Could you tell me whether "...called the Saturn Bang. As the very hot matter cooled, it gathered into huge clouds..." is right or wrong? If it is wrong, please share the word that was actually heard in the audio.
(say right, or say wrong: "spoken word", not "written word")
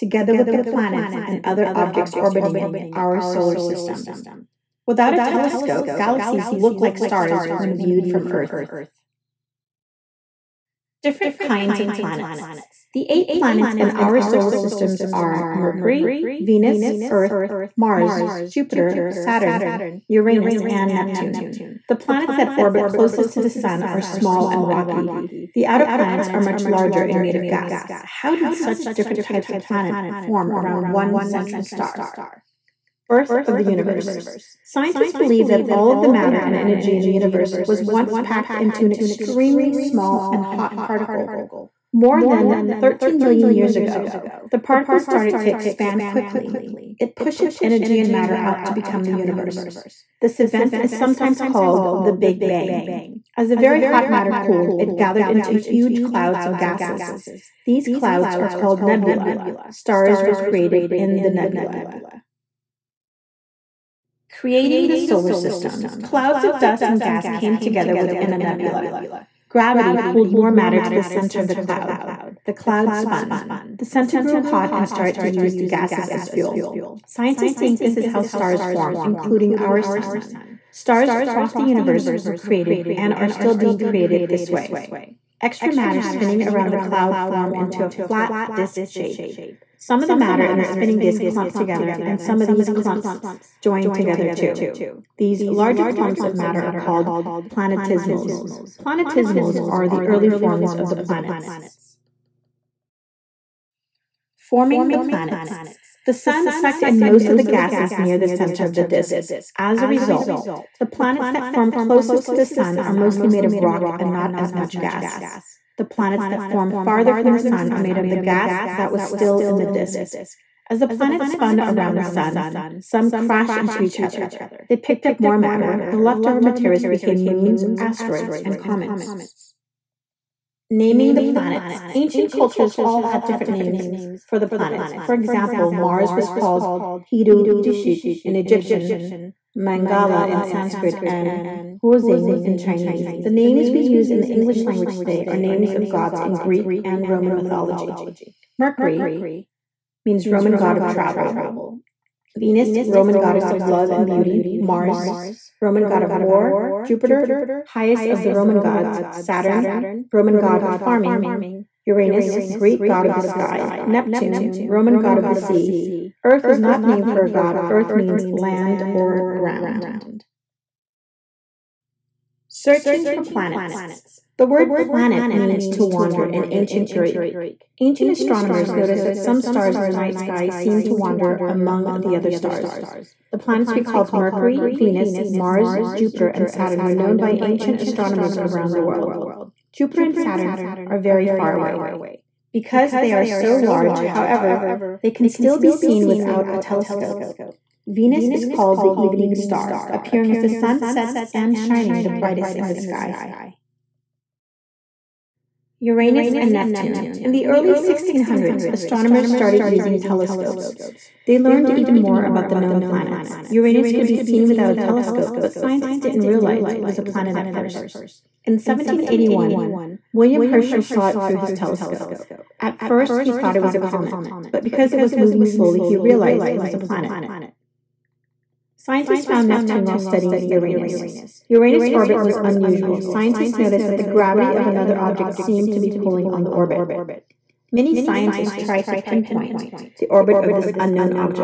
wrong: "Big", not "Saturn".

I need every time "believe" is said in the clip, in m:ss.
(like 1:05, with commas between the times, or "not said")
0:35.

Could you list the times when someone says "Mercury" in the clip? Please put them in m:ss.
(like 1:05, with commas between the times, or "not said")
0:15, 2:28, 3:04.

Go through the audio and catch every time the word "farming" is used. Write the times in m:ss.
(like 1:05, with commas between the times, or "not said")
2:40.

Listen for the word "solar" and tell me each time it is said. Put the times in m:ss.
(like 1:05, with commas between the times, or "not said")
0:03, 0:14, 1:04.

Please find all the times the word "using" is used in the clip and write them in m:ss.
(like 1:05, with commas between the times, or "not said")
3:29.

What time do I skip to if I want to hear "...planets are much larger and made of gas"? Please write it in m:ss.
0:25.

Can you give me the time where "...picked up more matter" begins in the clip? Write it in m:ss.
2:04.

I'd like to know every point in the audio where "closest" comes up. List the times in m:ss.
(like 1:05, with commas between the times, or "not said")
0:22, 1:51.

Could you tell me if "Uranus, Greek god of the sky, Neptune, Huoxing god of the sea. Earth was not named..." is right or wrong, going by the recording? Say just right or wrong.
wrong.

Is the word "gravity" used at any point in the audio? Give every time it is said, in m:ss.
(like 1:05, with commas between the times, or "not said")
1:09, 3:54.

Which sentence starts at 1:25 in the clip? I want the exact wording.
Extra matter spinning around the cloud form into a flat disk shape.